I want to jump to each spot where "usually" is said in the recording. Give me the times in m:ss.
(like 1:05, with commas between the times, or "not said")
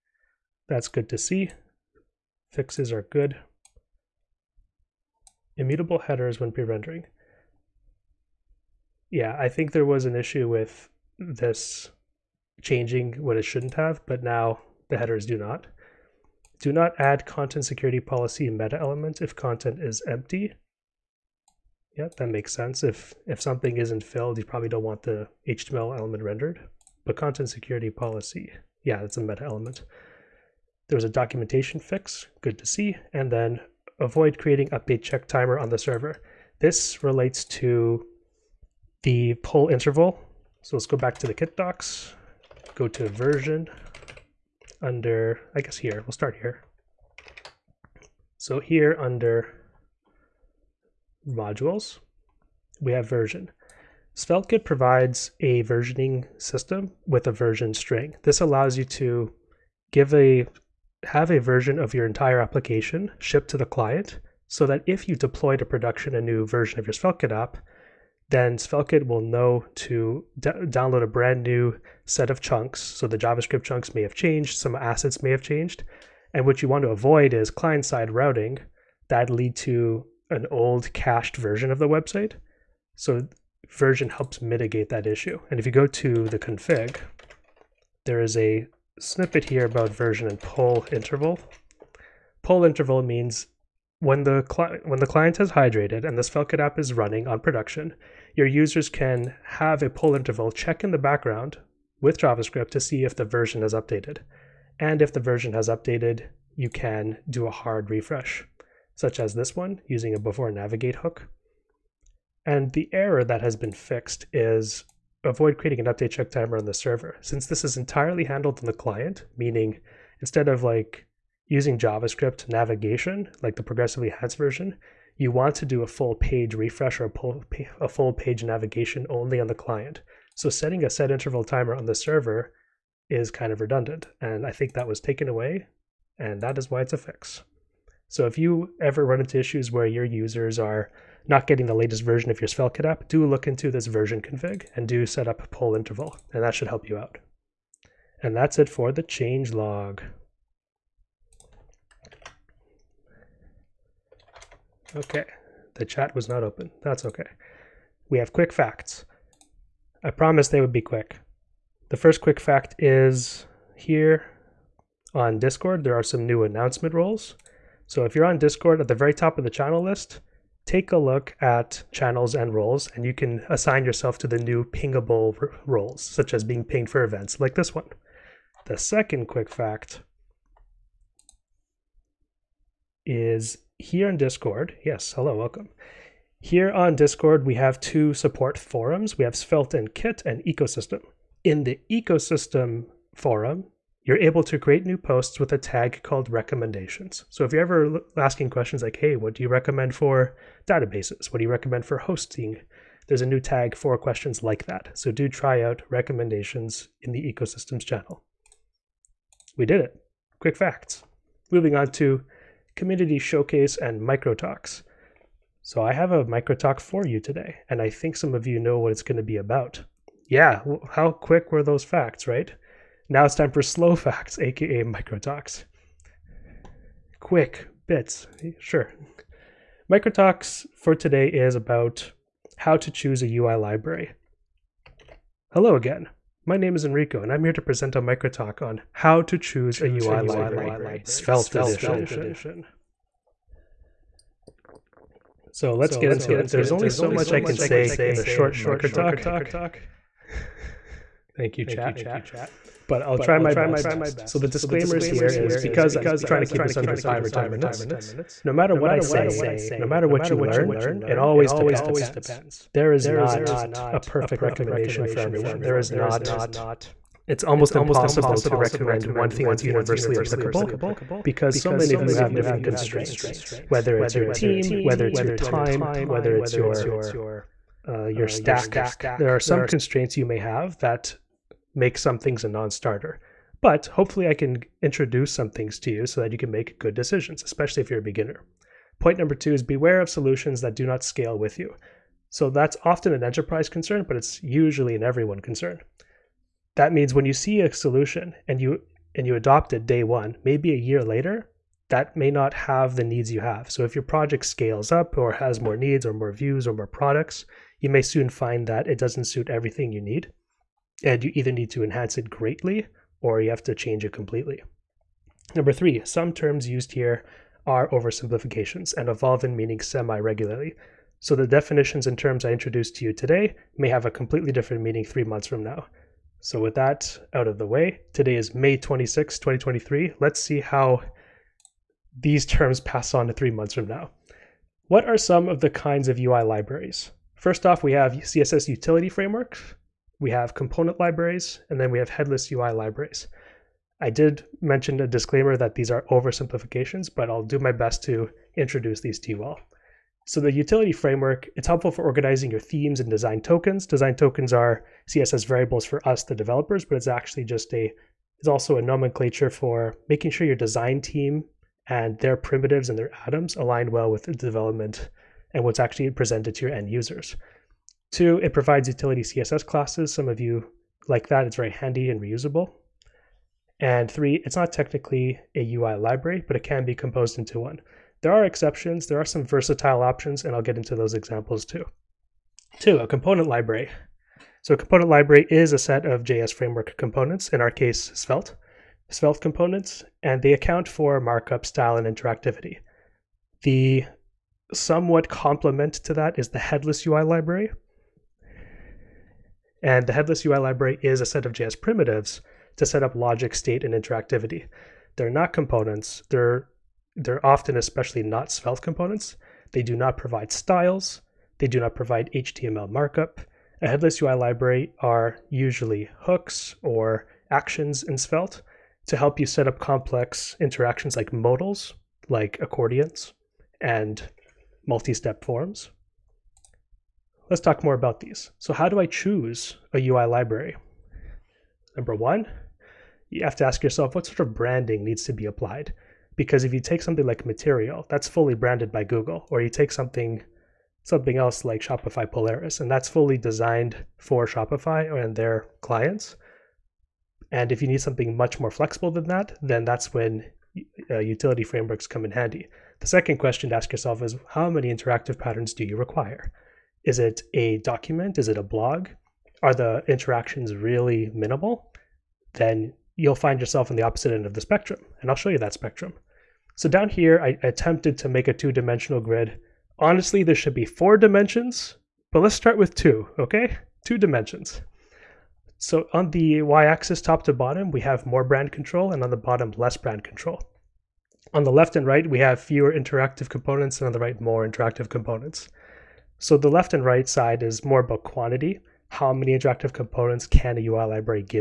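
4:54, 6:55.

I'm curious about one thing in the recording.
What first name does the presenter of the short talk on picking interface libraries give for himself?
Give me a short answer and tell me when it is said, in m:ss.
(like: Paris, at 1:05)
Enrico, at 3:56.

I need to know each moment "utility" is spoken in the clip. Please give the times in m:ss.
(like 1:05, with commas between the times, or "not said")
5:38, 5:50, 6:08, 7:31.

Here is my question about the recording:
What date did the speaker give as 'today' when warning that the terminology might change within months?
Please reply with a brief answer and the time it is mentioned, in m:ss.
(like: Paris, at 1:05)
May 26, 2023, at 5:28.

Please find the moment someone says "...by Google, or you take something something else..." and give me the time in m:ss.
7:18.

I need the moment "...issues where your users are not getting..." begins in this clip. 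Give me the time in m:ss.
2:19.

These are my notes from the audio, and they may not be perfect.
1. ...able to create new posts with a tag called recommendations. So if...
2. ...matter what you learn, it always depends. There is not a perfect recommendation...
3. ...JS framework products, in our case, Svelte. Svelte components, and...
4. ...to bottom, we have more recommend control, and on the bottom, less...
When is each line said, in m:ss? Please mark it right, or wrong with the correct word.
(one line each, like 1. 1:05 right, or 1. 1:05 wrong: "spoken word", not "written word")
1. 3:14 right
2. 4:19 right
3. 6:26 wrong: "components", not "products"
4. 7:57 wrong: "brand", not "recommend".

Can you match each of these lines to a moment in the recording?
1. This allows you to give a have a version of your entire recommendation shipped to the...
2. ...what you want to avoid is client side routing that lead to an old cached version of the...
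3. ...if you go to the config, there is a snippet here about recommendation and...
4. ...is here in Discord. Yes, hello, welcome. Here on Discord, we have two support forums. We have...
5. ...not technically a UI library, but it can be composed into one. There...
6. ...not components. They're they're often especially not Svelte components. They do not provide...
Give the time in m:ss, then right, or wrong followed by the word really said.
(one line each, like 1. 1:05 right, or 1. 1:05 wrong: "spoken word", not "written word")
1. 0:58 wrong: "application", not "recommendation"
2. 1:16 right
3. 1:25 wrong: "version", not "recommendation"
4. 3:03 right
5. 6:14 right
6. 6:45 right.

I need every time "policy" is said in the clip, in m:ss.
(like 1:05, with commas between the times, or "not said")
0:18, 0:27.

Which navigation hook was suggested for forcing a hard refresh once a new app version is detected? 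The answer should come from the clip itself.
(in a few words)
before navigate.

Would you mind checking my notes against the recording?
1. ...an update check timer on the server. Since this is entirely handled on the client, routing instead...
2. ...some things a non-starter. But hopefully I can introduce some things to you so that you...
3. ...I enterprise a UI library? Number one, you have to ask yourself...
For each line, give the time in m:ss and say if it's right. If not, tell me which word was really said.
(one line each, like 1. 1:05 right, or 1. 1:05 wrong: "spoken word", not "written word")
1. 1:55 wrong: "meaning", not "routing"
2. 4:41 right
3. 7:09 wrong: "choose", not "enterprise".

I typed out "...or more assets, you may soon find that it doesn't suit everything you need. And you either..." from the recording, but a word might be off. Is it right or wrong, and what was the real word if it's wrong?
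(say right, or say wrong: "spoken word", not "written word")
wrong: "products", not "assets".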